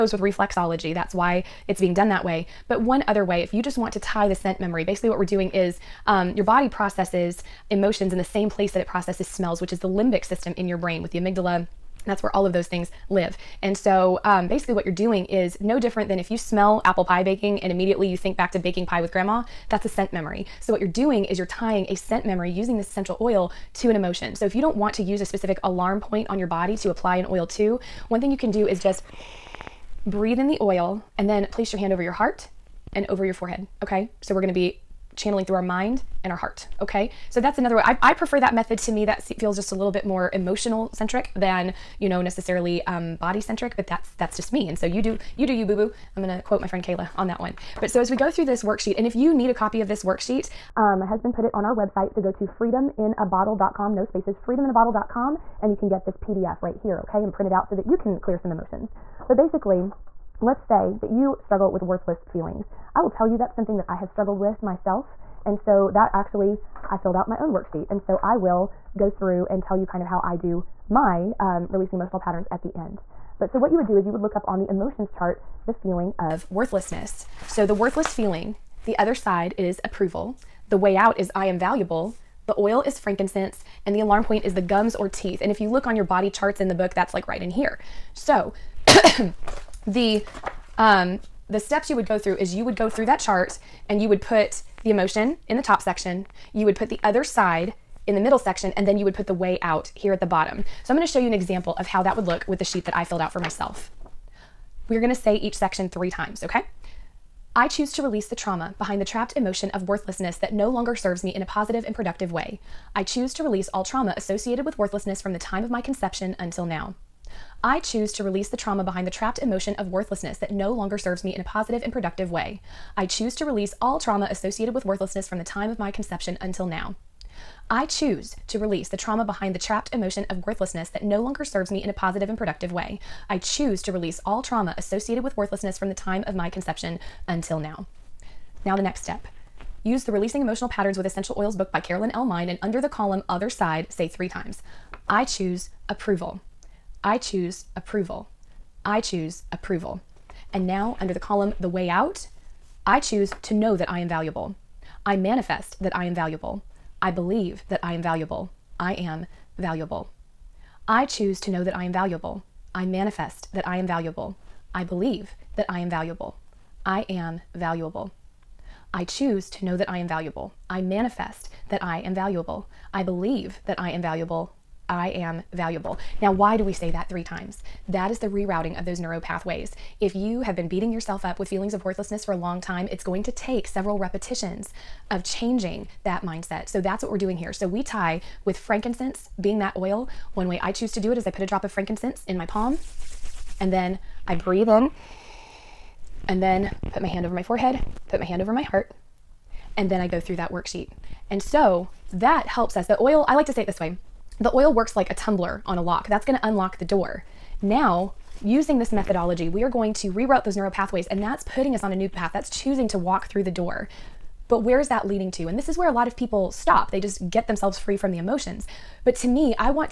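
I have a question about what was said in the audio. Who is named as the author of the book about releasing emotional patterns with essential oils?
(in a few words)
Carolyn L. Mein.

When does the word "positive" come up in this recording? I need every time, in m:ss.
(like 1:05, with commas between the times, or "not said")
1:51, 2:01, 2:11.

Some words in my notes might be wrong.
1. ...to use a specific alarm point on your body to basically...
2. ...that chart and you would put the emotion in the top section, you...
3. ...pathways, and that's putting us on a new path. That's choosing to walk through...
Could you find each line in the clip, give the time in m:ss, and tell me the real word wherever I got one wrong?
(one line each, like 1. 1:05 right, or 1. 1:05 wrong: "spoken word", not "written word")
1. 0:24 wrong: "apply", not "basically"
2. 1:33 right
3. 3:30 right.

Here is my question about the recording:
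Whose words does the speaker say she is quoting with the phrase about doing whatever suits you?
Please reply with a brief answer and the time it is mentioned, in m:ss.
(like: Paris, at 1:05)
Kayla, at 0:46.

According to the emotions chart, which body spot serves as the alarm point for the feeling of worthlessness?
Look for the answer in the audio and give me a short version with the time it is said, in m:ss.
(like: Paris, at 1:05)
gums or teeth, at 1:24.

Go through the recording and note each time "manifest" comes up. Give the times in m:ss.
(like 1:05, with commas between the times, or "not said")
2:35, 2:42, 2:50.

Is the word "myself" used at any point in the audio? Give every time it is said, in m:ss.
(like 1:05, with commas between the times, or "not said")
1:04, 1:43.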